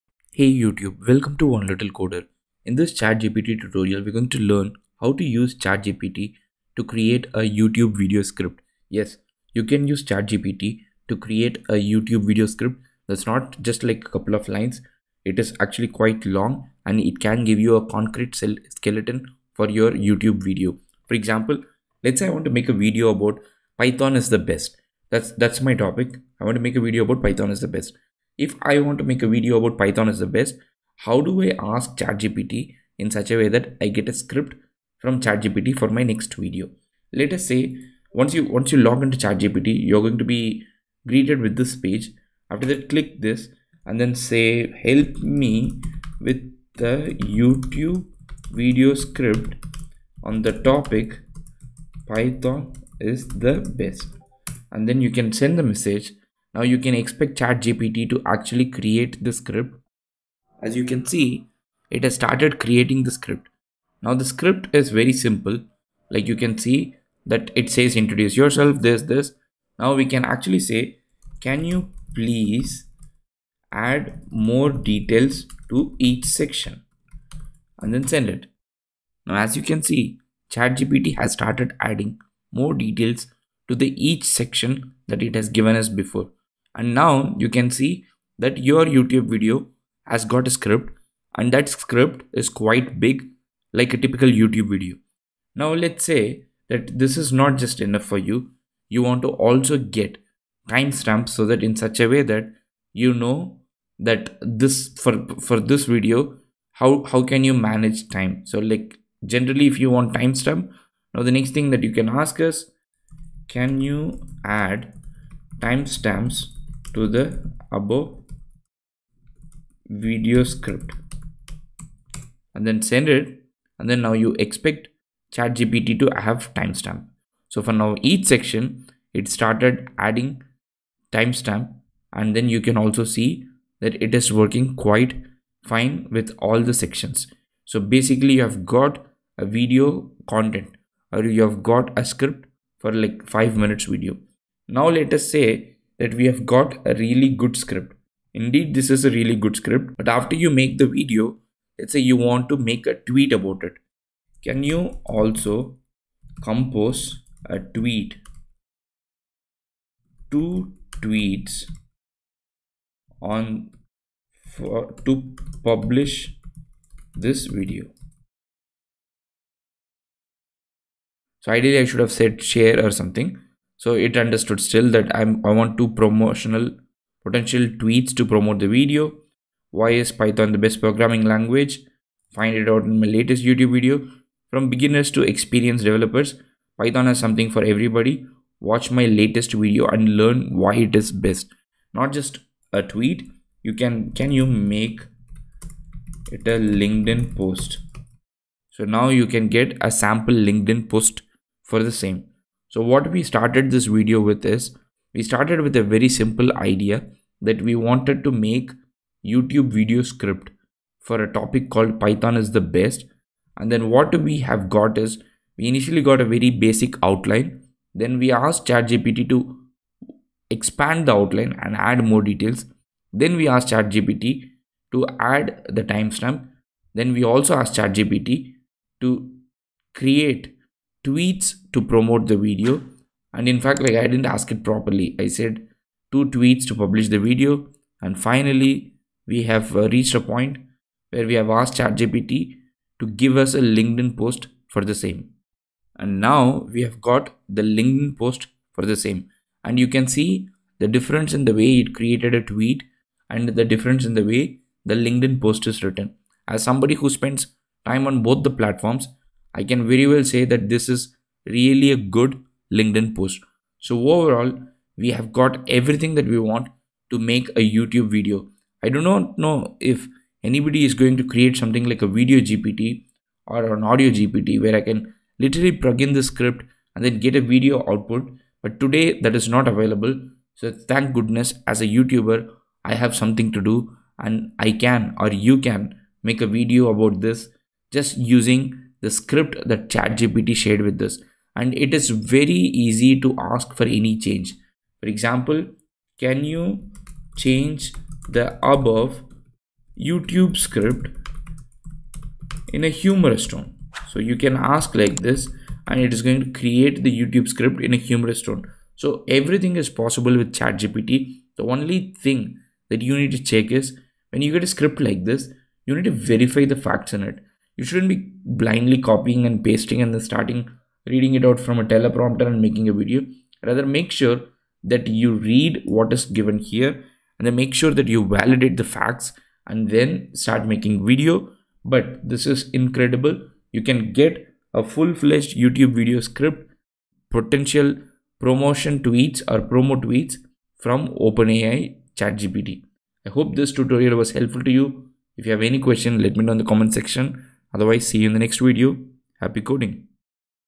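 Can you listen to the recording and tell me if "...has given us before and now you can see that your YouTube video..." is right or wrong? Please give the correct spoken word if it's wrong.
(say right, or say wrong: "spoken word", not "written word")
right.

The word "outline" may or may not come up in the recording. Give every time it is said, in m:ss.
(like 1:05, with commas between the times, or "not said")
3:37, 3:41.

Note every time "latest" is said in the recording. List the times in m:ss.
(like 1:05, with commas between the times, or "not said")
3:03, 3:09.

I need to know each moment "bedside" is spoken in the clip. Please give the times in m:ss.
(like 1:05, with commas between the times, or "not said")
not said.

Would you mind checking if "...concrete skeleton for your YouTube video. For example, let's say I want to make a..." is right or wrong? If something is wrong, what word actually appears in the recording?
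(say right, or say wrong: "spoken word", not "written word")
right.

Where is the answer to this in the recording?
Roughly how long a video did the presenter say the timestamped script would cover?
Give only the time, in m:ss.
2:23.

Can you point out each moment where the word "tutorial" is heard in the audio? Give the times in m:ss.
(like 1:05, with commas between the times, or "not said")
0:03, 5:43.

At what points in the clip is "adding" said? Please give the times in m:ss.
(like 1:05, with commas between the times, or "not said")
1:21, 2:09.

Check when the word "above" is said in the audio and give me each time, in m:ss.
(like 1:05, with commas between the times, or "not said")
1:57, 4:58.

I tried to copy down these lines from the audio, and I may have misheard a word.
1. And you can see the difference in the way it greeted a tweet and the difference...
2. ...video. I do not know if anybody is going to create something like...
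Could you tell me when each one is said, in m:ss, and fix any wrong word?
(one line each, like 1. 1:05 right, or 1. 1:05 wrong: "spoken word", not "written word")
1. 4:09 wrong: "created", not "greeted"
2. 4:28 right.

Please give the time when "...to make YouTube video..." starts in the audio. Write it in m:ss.
3:28.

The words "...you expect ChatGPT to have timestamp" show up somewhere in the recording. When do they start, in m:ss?
2:04.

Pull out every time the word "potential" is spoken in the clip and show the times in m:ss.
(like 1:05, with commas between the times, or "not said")
2:57, 5:37.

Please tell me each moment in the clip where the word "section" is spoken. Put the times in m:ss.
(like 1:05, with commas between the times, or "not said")
1:16, 1:24, 2:08, 2:16, 5:46.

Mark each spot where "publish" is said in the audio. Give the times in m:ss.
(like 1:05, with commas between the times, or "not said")
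2:45, 3:56.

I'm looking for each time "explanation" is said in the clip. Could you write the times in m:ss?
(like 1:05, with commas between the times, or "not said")
not said.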